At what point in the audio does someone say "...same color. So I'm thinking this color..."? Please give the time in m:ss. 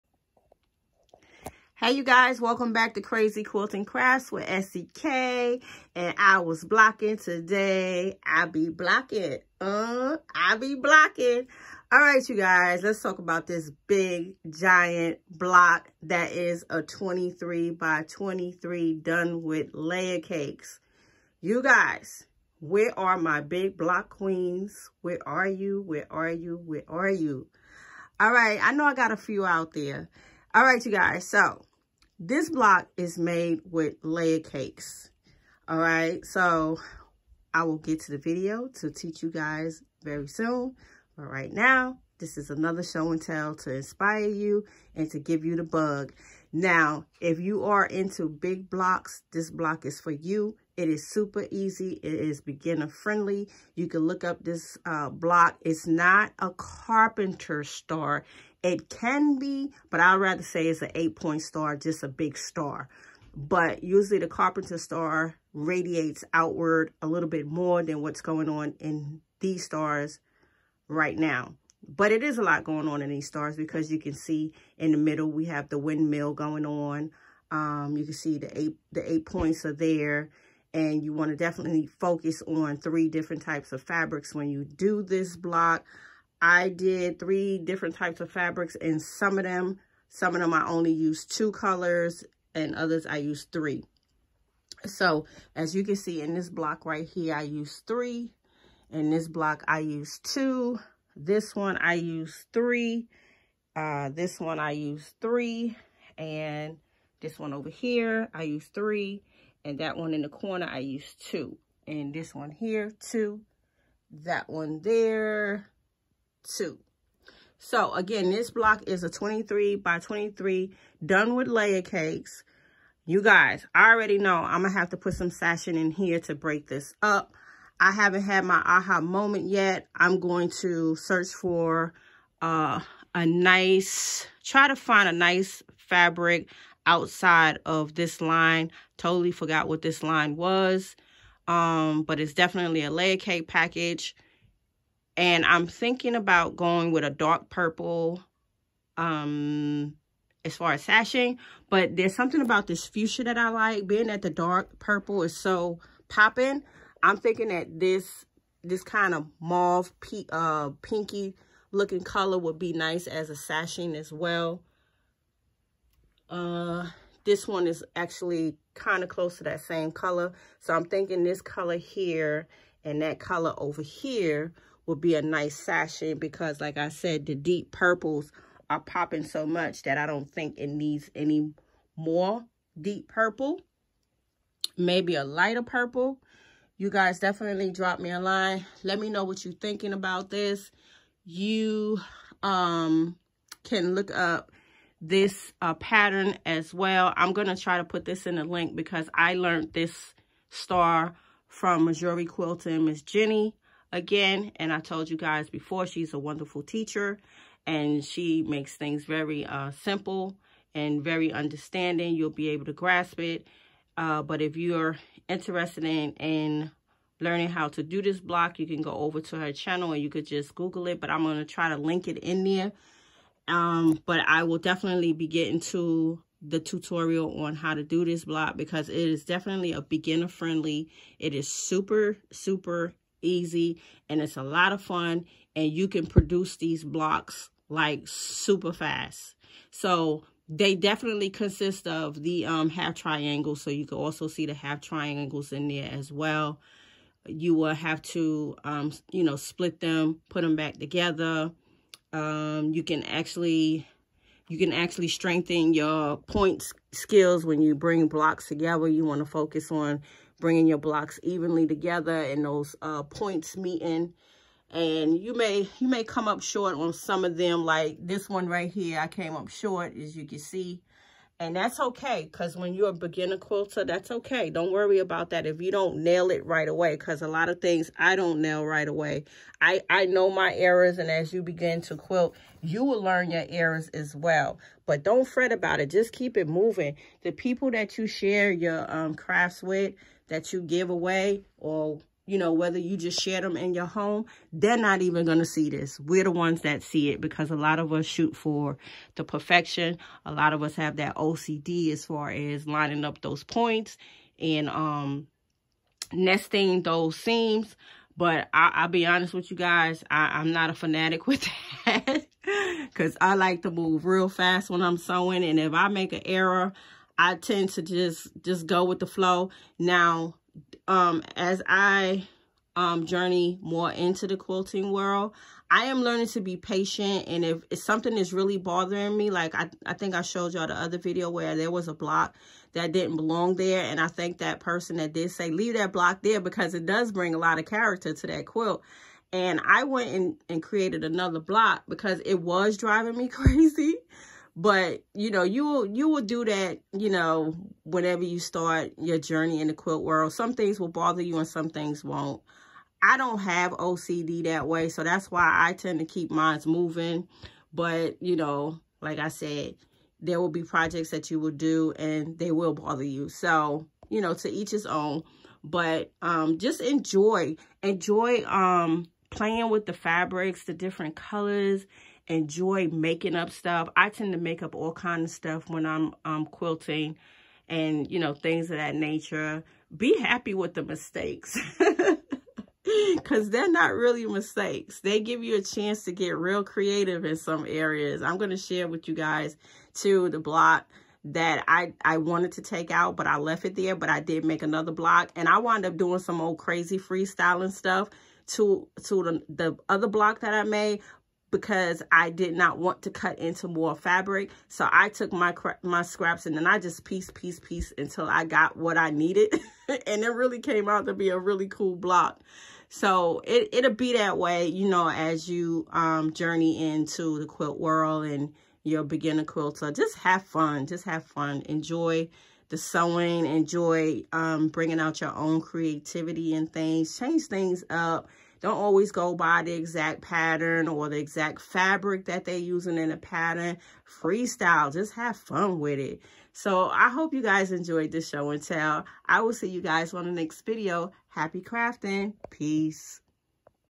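2:49.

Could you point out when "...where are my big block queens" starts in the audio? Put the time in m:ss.
0:22.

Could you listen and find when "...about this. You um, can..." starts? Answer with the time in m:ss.
3:09.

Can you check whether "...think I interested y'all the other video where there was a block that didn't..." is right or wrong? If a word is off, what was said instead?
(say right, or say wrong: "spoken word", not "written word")
wrong: "showed", not "interested".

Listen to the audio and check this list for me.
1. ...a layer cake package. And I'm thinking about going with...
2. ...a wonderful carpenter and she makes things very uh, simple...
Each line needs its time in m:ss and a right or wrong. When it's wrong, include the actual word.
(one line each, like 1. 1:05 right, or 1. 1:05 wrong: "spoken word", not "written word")
1. 2:22 right
2. 3:26 wrong: "teacher", not "carpenter".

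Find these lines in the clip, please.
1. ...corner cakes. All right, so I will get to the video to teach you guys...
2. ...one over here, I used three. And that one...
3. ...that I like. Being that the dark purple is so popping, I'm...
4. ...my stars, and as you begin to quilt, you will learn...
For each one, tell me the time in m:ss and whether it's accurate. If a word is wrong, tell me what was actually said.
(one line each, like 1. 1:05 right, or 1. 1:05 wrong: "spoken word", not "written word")
1. 0:34 wrong: "layer", not "corner"
2. 1:47 right
3. 2:33 right
4. 4:40 wrong: "errors", not "stars".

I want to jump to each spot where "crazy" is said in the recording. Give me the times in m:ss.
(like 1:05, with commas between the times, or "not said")
5:43, 6:36.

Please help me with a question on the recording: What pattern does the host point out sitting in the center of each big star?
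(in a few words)
windmill.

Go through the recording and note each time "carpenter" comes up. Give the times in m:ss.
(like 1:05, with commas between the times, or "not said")
0:56, 1:04.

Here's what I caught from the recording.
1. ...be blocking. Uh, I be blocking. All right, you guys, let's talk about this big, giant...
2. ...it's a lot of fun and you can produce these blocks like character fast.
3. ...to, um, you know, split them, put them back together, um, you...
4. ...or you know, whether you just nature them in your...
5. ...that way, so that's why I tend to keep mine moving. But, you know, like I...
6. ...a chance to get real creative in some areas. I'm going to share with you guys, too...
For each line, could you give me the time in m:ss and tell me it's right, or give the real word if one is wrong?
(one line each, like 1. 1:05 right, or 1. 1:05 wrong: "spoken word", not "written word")
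1. 0:08 right
2. 3:54 wrong: "super", not "character"
3. 4:08 right
4. 4:51 wrong: "share", not "nature"
5. 5:54 right
6. 6:25 right.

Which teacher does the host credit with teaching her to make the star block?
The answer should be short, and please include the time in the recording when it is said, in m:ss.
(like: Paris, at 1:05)
Missouri Quilting Miss Jenny, at 3:21.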